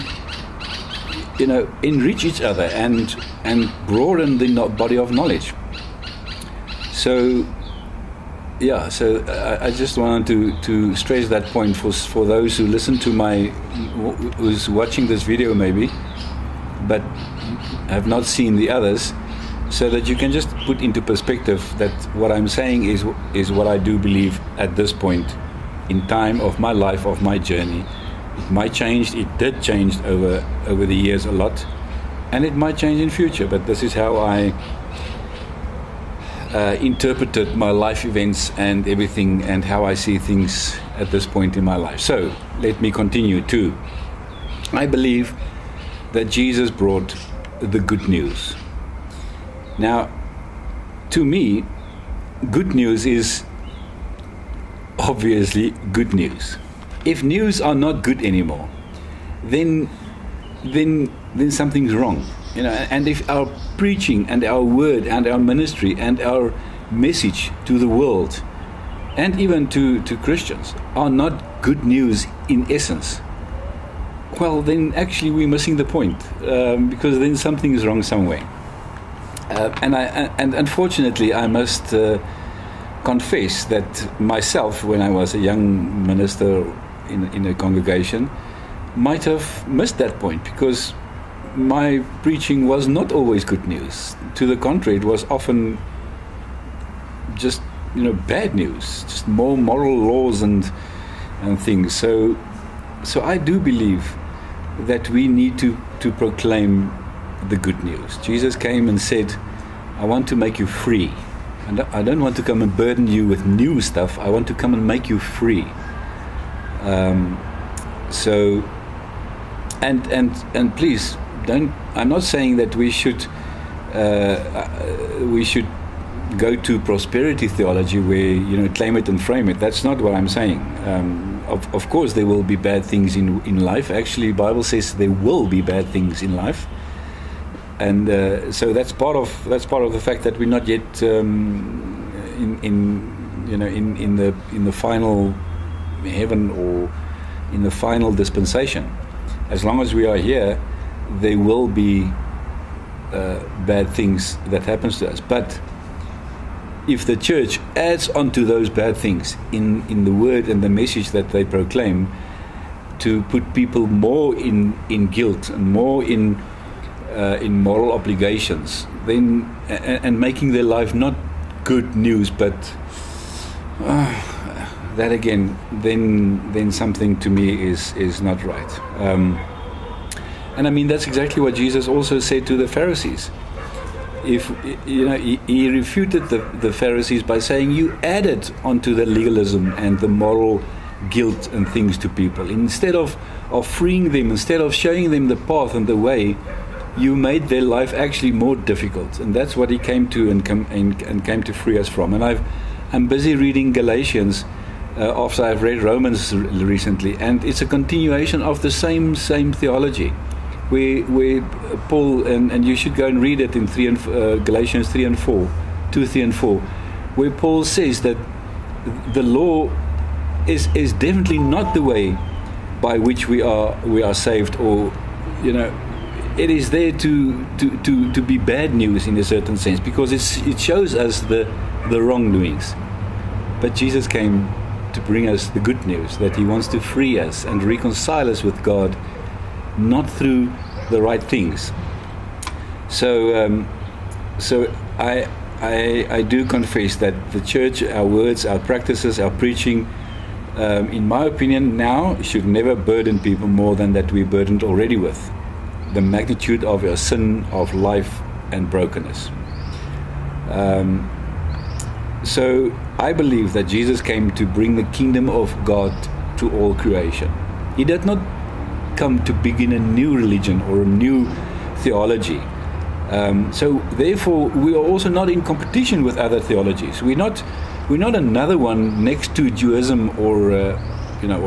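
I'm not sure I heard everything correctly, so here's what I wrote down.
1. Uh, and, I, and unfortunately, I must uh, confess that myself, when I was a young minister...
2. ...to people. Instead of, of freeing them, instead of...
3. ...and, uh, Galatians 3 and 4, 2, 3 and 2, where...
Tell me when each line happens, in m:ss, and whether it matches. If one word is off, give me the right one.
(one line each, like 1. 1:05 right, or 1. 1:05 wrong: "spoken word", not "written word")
1. 1:19 right
2. 3:11 right
3. 3:33 wrong: "4", not "2".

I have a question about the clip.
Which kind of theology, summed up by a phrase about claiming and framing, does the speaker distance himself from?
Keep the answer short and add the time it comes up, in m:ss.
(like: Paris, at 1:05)
Prosperity theology, at 2:06.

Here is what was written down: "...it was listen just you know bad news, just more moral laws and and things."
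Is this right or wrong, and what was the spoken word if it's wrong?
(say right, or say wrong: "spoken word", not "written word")
wrong: "often", not "listen".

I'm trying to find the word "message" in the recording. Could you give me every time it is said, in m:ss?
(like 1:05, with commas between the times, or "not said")
1:06, 2:40.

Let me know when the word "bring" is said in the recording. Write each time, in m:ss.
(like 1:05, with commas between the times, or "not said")
3:55, 4:24.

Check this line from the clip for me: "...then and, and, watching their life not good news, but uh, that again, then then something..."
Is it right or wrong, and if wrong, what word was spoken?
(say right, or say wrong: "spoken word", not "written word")
wrong: "making", not "watching".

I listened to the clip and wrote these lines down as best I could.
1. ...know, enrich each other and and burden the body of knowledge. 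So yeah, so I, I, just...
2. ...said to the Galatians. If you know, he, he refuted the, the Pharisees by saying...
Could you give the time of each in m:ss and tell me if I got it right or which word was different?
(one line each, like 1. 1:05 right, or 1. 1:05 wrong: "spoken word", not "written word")
1. 0:01 wrong: "broaden", not "burden"
2. 3:02 wrong: "Pharisees", not "Galatians".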